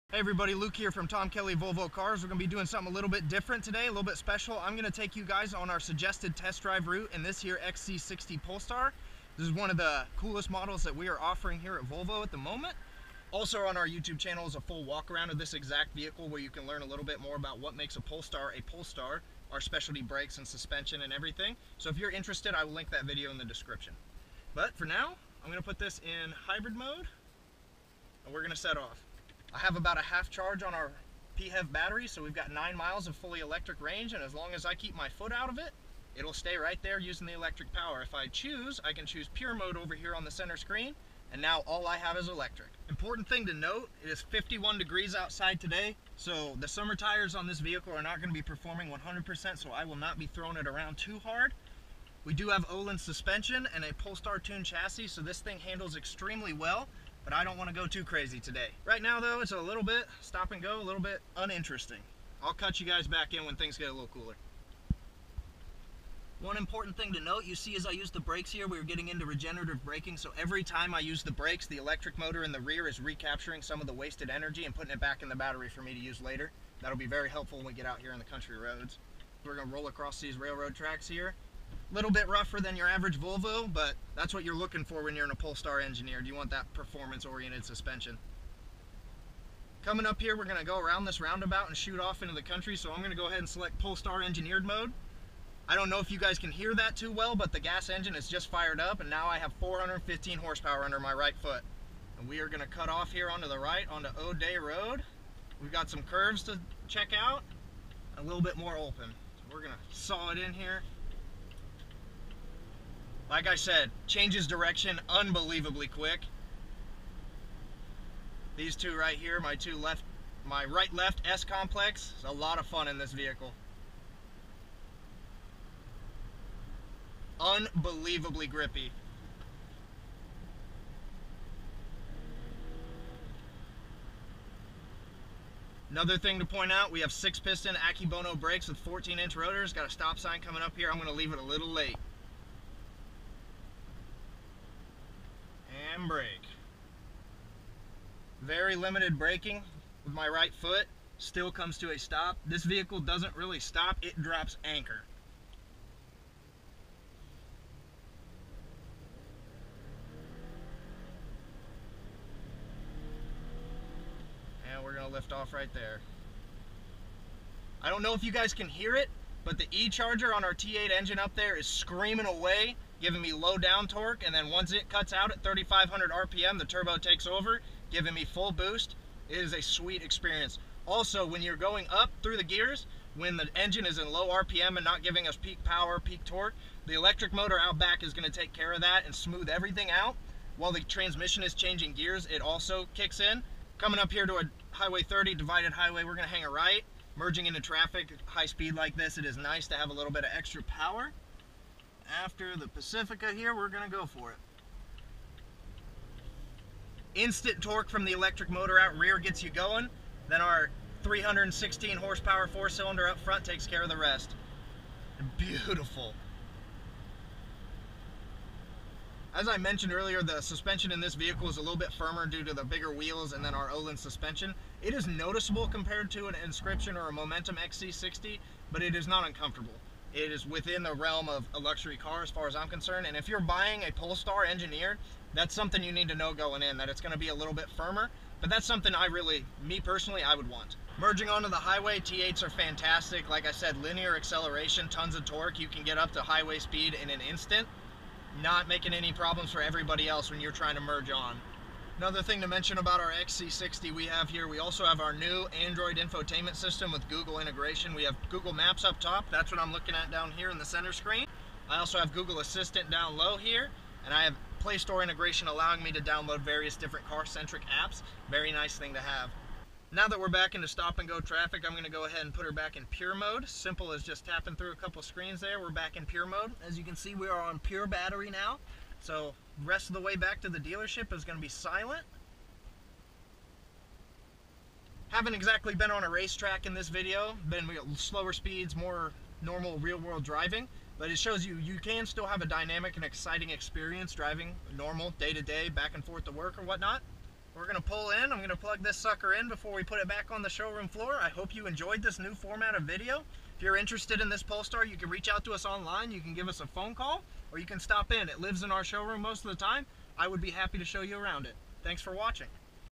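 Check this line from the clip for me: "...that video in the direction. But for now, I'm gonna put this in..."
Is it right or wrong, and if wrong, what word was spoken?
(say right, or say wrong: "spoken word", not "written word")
wrong: "description", not "direction".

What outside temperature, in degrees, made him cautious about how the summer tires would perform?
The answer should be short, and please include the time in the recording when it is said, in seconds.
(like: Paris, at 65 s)
51, at 44 s.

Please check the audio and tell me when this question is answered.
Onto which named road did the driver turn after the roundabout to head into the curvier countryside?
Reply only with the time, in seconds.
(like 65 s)
104 s.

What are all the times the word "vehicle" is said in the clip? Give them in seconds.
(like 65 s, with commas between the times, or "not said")
15 s, 47 s, 123 s, 152 s, 221 s.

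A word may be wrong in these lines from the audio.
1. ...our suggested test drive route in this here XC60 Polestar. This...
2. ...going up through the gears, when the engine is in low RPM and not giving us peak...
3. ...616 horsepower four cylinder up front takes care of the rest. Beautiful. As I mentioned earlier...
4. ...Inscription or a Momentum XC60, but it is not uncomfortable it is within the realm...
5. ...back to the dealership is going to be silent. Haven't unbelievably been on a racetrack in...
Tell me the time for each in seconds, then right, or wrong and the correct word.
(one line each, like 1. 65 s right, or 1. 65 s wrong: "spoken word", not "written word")
1. 5 s right
2. 181 s right
3. 211 s wrong: "316", not "616"
4. 226 s right
5. 280 s wrong: "exactly", not "unbelievably".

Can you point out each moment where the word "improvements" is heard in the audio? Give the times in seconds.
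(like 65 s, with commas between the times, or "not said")
not said.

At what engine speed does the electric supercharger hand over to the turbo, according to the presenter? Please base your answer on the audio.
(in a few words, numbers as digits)
3,500 RPM.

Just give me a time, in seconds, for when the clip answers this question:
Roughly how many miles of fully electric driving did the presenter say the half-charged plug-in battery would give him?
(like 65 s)
32 s.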